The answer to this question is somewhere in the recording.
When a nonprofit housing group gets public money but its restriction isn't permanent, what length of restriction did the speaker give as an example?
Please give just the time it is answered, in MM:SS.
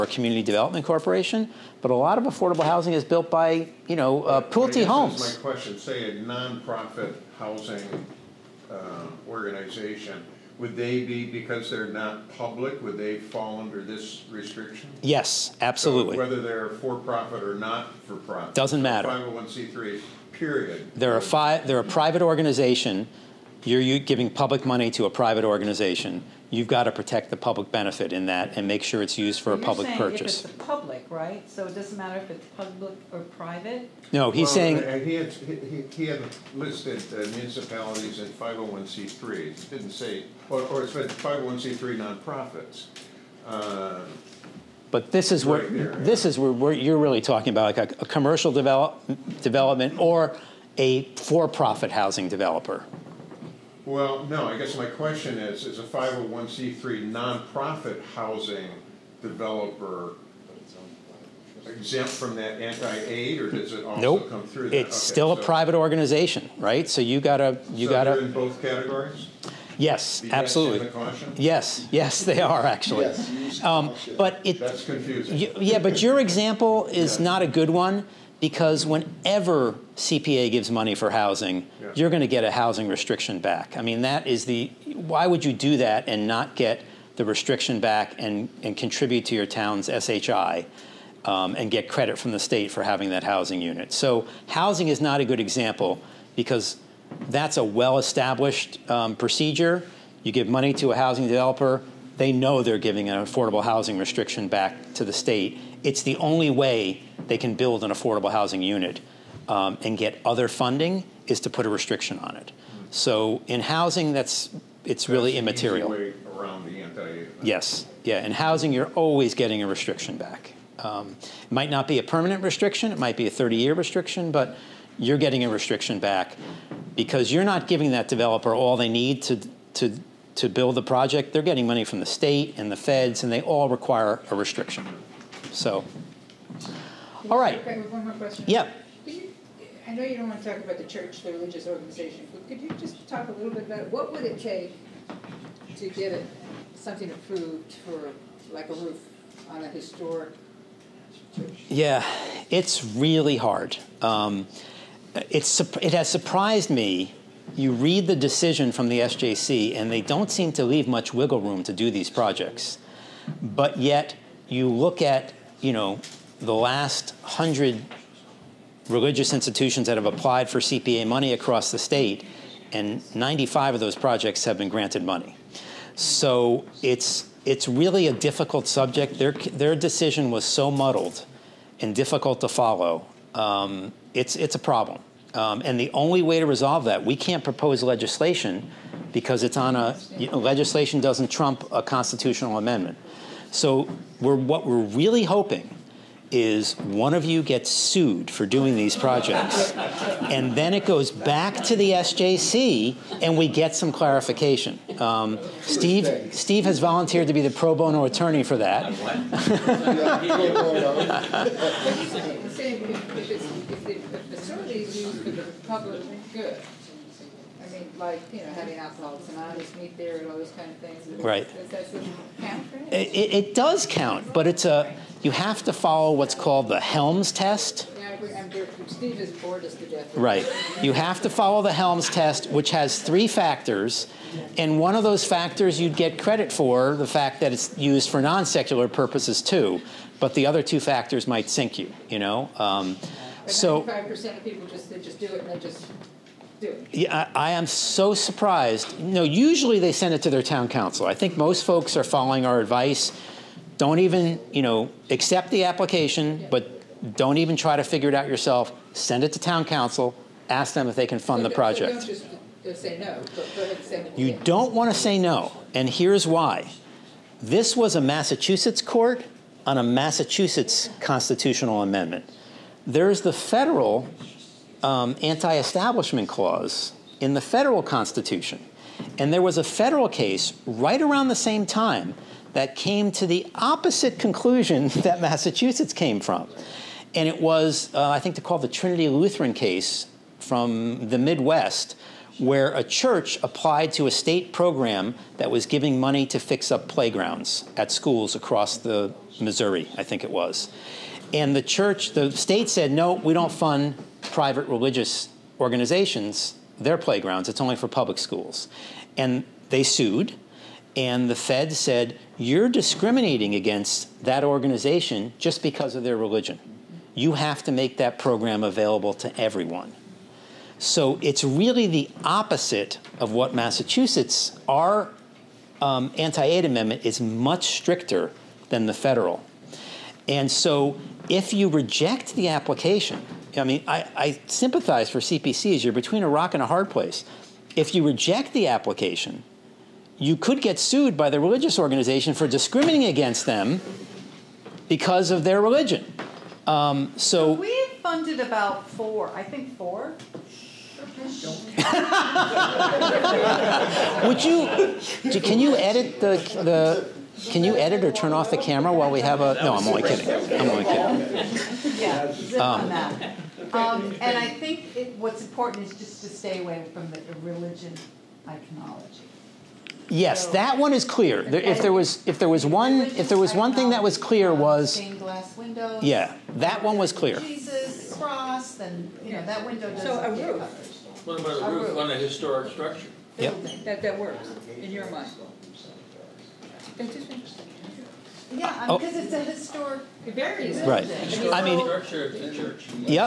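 02:03.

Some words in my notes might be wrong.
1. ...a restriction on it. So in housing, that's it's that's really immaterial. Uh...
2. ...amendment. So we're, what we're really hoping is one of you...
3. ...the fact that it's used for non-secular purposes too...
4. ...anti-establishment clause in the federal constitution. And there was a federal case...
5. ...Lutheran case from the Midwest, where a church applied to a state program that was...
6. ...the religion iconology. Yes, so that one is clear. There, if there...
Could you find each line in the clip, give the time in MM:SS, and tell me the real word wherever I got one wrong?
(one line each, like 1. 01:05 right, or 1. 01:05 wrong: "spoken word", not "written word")
1. 01:51 right
2. 03:12 right
3. 03:56 right
4. 04:35 right
5. 04:49 right
6. 06:07 right.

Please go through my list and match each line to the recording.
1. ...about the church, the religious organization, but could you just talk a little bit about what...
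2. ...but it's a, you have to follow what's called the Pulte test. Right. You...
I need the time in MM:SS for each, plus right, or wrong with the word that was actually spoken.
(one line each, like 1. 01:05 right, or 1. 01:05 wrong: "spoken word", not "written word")
1. 02:20 right
2. 03:44 wrong: "Helmes", not "Pulte".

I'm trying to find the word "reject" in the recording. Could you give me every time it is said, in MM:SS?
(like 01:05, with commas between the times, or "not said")
05:31, 05:38.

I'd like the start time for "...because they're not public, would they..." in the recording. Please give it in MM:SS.
00:11.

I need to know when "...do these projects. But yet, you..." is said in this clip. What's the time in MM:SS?
02:41.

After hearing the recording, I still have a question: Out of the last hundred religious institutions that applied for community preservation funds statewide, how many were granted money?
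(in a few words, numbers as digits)
95.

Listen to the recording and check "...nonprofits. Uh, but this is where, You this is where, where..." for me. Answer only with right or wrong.
wrong.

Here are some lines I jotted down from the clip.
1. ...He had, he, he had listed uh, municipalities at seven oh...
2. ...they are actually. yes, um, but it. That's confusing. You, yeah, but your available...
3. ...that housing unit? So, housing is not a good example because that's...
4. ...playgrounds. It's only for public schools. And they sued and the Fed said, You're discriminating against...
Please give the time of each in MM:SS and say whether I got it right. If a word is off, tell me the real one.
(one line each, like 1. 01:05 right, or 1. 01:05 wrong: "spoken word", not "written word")
1. 00:34 wrong: "five", not "seven"
2. 01:12 wrong: "example", not "available"
3. 01:33 right
4. 05:06 right.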